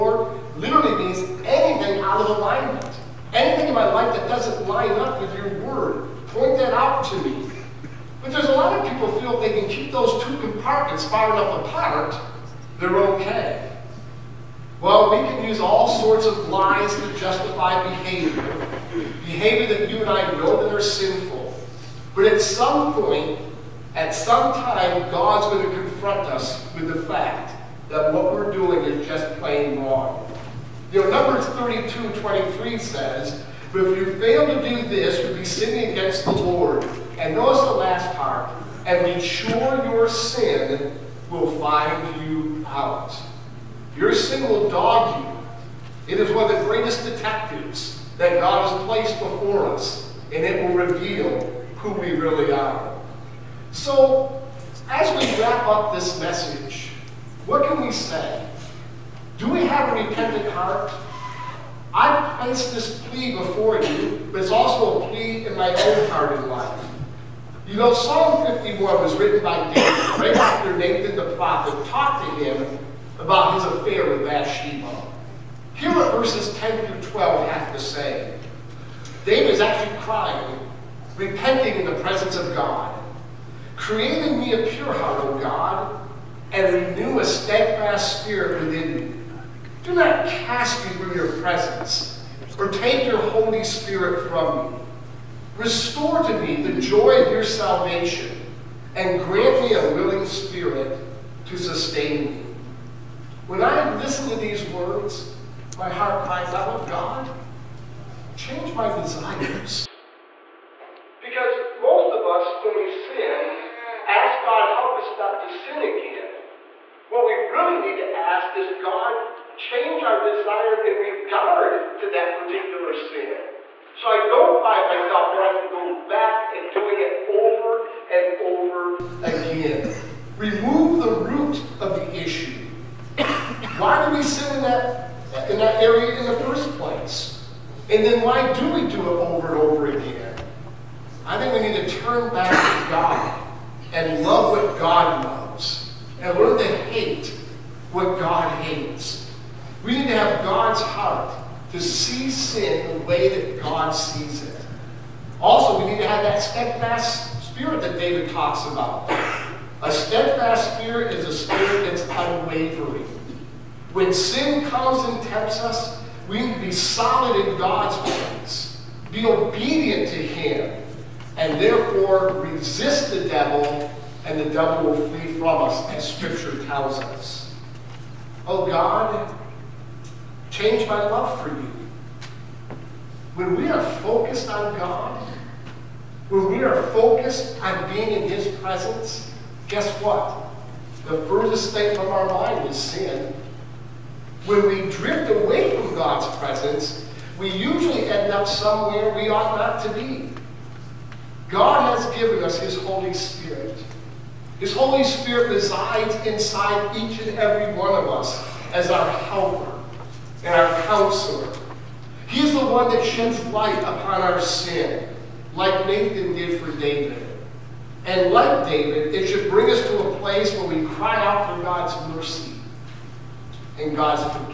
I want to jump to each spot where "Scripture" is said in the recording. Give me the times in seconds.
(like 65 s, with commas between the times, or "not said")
176 s.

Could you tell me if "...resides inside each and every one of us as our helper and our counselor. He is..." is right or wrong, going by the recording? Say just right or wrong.
right.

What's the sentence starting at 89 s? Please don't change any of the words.
Do not cast me from your presence, or take your Holy Spirit from me.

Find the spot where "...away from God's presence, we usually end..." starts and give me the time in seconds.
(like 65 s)
195 s.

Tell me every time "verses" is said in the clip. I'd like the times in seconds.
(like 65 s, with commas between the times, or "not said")
76 s.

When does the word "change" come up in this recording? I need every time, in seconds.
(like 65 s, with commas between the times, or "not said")
108 s, 119 s, 180 s.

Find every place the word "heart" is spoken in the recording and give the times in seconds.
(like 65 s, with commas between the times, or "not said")
60 s, 66 s, 84 s, 105 s, 150 s.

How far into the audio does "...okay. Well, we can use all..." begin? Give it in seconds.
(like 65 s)
12 s.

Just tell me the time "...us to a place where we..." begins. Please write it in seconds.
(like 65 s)
219 s.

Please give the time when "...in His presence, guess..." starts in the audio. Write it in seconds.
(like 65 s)
188 s.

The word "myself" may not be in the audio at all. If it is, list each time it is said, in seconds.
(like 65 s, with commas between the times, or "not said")
124 s.